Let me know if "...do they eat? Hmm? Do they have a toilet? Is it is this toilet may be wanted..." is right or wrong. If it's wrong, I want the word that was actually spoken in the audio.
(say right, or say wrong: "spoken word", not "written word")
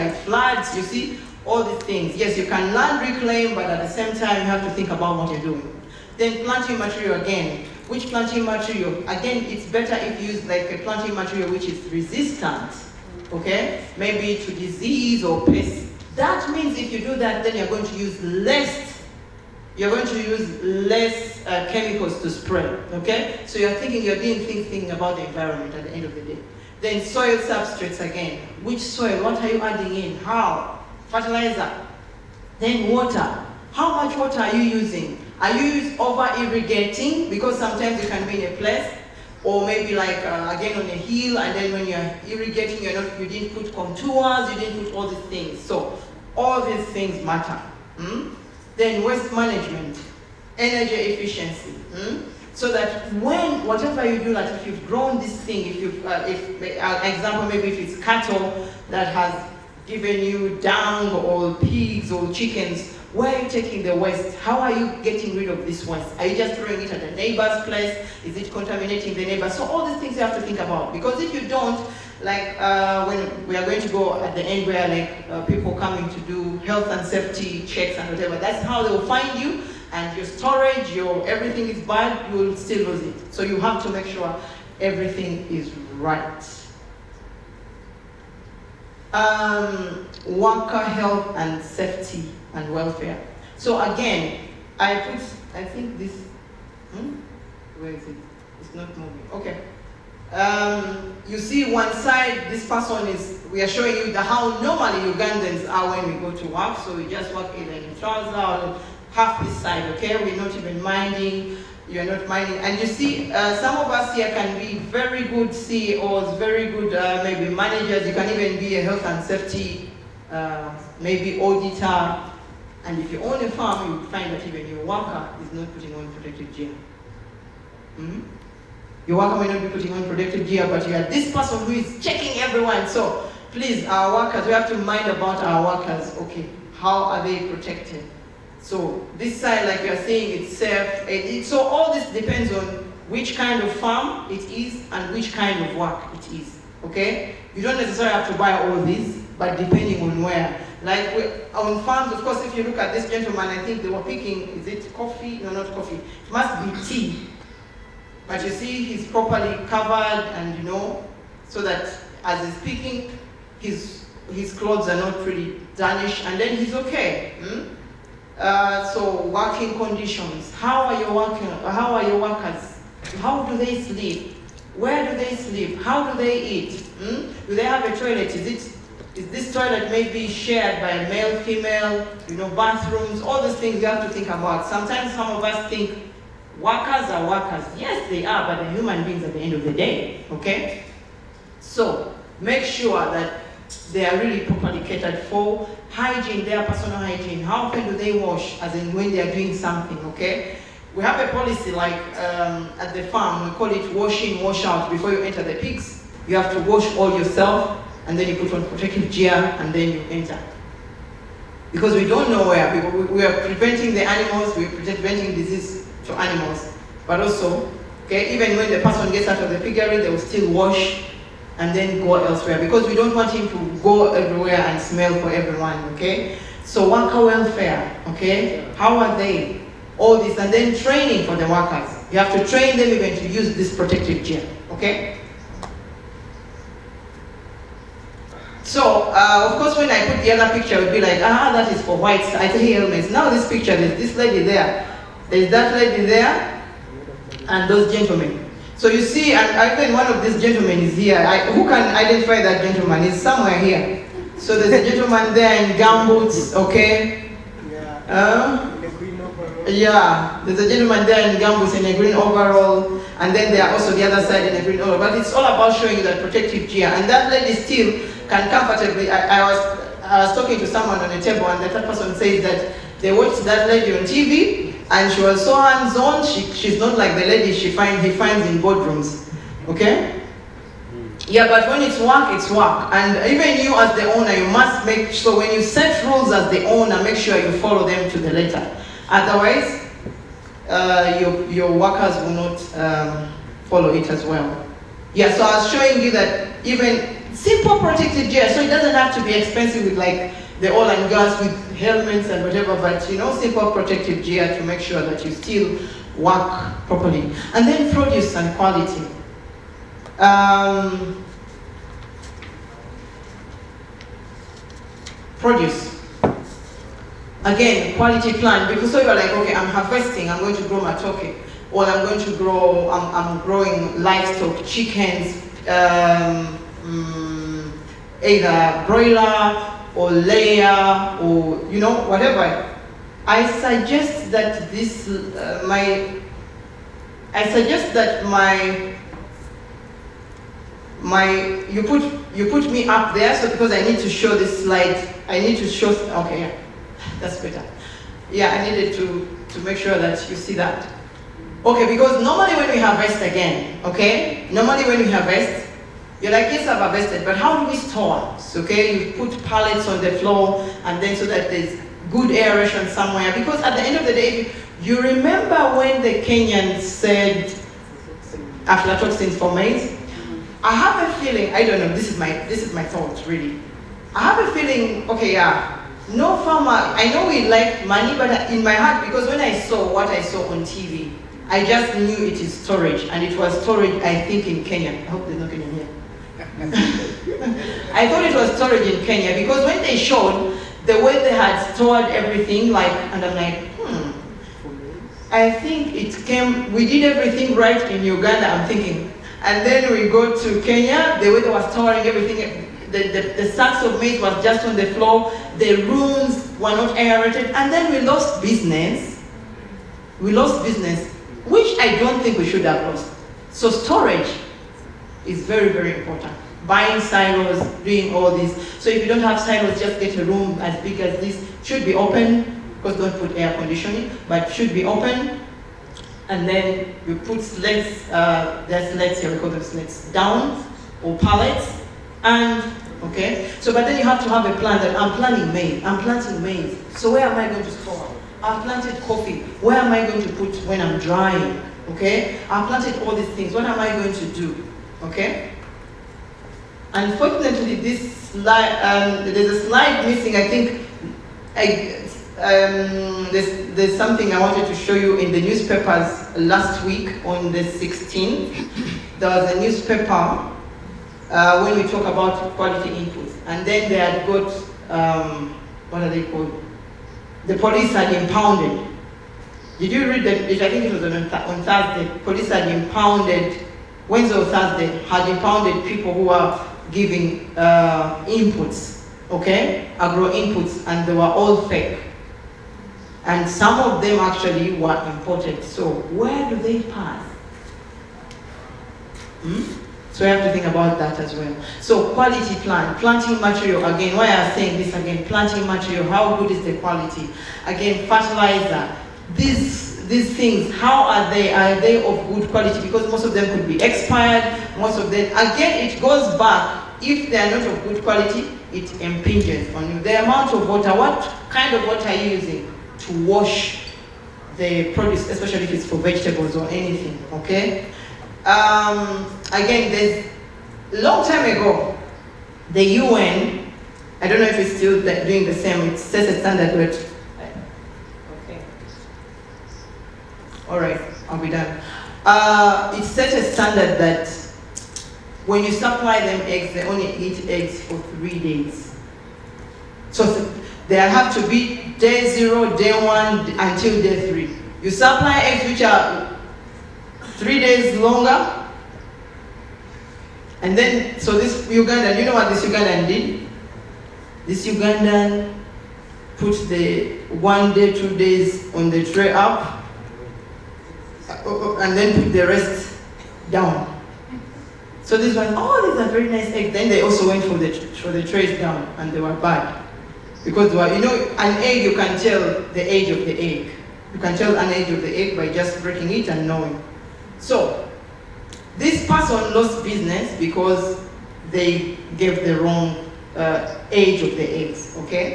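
wrong: "shared", not "wanted".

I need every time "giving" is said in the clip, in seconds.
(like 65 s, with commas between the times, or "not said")
476 s.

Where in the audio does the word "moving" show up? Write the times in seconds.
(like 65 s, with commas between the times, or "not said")
98 s.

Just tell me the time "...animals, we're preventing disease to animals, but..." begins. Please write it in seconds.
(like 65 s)
214 s.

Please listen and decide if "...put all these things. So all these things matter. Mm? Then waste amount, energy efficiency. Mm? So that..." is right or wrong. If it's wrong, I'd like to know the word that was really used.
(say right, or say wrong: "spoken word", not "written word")
wrong: "management", not "amount".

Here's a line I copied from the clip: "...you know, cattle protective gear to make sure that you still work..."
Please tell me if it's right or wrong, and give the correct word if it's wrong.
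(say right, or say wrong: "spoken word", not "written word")
wrong: "simple", not "cattle".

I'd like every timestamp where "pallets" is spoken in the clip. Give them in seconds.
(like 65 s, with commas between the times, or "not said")
359 s, 431 s.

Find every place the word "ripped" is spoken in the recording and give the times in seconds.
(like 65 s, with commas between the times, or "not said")
not said.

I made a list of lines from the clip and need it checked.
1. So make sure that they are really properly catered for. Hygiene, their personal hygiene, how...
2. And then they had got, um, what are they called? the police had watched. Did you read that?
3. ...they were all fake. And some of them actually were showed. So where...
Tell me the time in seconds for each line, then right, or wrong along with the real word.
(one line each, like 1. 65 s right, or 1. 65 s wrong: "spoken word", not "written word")
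1. 191 s right
2. 463 s wrong: "impounded", not "watched"
3. 481 s wrong: "imported", not "showed".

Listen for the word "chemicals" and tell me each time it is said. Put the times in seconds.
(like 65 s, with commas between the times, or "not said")
21 s.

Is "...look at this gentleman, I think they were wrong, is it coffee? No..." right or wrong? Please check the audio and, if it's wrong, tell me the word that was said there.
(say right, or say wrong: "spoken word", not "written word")
wrong: "picking", not "wrong".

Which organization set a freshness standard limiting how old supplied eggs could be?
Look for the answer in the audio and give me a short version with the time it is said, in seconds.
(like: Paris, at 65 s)
the UN, at 522 s.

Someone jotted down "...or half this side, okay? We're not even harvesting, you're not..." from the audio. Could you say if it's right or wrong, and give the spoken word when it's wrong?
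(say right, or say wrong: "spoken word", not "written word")
wrong: "minding", not "harvesting".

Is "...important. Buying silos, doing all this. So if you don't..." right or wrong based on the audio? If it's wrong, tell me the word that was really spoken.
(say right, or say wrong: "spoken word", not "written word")
right.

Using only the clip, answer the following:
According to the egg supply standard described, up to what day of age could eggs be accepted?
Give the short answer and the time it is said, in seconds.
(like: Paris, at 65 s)
day 3, at 544 s.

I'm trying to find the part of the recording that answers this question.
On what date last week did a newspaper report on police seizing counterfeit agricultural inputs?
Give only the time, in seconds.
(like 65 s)
457 s.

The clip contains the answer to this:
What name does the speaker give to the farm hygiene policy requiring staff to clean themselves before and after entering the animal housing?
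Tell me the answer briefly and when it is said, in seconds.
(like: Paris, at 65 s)
wash in, wash out, at 203 s.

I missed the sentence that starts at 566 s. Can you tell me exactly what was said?
Then they also went for the, for the trays down, and they were bad.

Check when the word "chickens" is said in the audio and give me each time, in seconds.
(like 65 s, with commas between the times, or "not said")
62 s, 324 s.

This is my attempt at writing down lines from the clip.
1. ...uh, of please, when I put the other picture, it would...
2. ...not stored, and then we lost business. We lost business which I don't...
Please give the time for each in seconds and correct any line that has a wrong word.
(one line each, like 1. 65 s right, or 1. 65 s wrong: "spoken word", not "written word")
1. 239 s wrong: "course", not "please"
2. 406 s wrong: "aerated", not "stored".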